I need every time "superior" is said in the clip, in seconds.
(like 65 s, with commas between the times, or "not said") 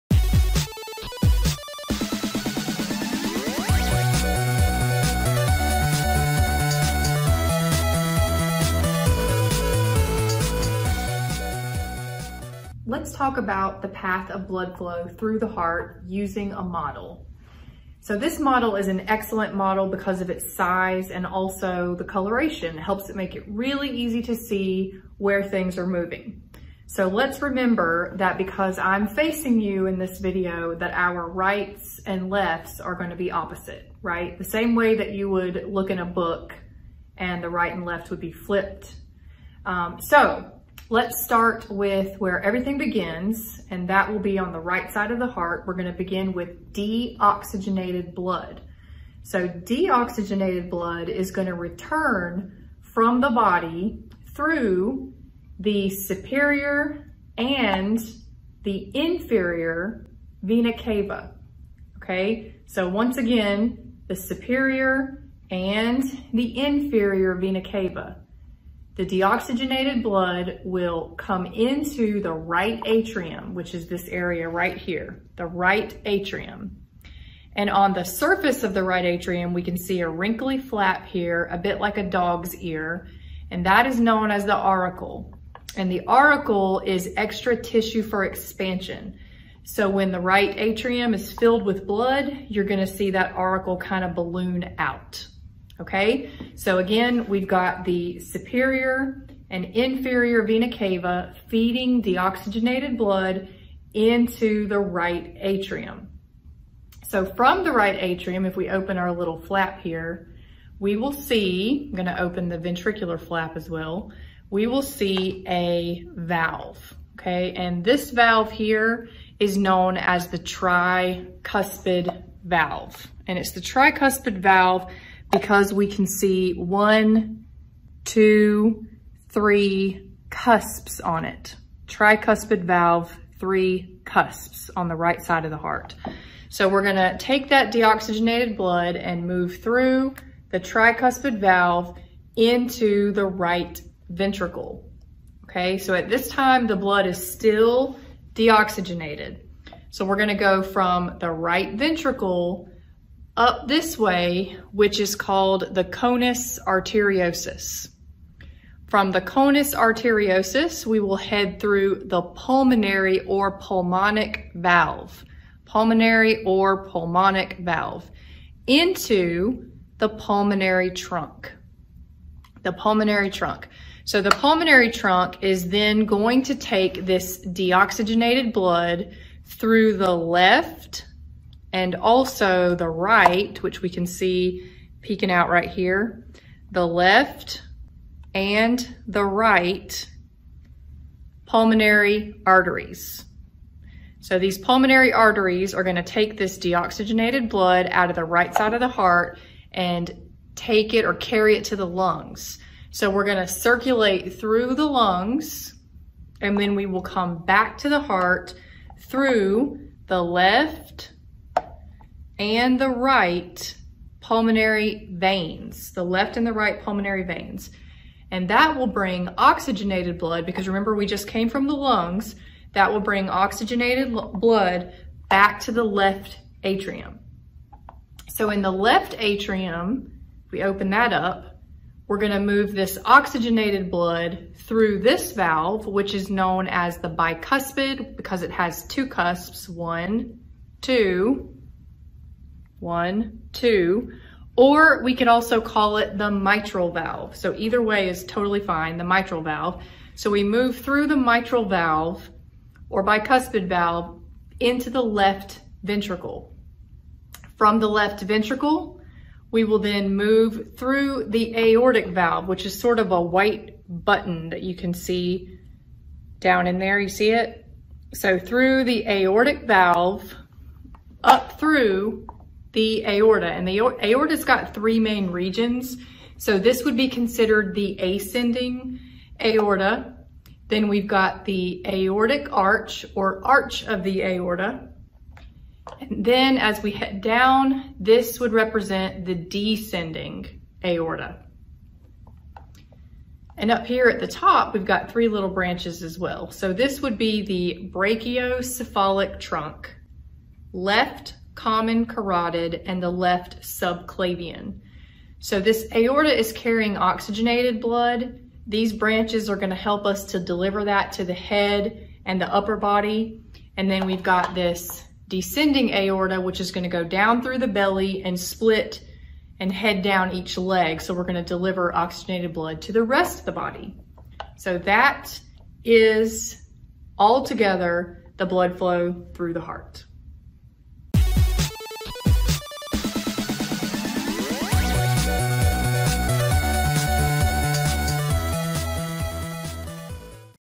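55 s, 64 s, 98 s.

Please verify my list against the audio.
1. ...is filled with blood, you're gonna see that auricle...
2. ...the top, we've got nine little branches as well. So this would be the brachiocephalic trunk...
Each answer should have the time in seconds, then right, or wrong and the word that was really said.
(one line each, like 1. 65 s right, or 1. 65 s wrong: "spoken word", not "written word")
1. 91 s right
2. 294 s wrong: "three", not "nine".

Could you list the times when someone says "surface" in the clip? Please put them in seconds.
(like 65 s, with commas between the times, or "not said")
78 s.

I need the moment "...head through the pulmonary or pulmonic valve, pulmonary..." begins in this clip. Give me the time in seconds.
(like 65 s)
161 s.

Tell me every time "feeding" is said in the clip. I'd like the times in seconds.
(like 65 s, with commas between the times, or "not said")
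101 s.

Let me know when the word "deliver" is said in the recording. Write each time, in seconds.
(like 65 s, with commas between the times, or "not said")
310 s, 321 s.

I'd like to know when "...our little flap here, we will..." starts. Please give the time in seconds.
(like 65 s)
108 s.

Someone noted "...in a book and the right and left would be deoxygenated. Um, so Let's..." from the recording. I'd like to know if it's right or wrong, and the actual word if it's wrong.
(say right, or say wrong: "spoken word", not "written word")
wrong: "flipped", not "deoxygenated".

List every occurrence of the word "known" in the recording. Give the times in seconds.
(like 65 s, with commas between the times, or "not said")
83 s, 119 s, 236 s.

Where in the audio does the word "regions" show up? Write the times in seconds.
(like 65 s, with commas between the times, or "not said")
275 s.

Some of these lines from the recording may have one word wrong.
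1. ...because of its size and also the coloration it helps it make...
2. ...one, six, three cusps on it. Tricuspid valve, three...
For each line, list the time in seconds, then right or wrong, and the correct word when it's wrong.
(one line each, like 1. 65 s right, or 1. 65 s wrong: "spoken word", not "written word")
1. 19 s right
2. 126 s wrong: "two", not "six".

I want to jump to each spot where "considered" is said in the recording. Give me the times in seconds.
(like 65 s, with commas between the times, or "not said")
277 s.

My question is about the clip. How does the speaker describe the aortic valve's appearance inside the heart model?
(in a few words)
A white button.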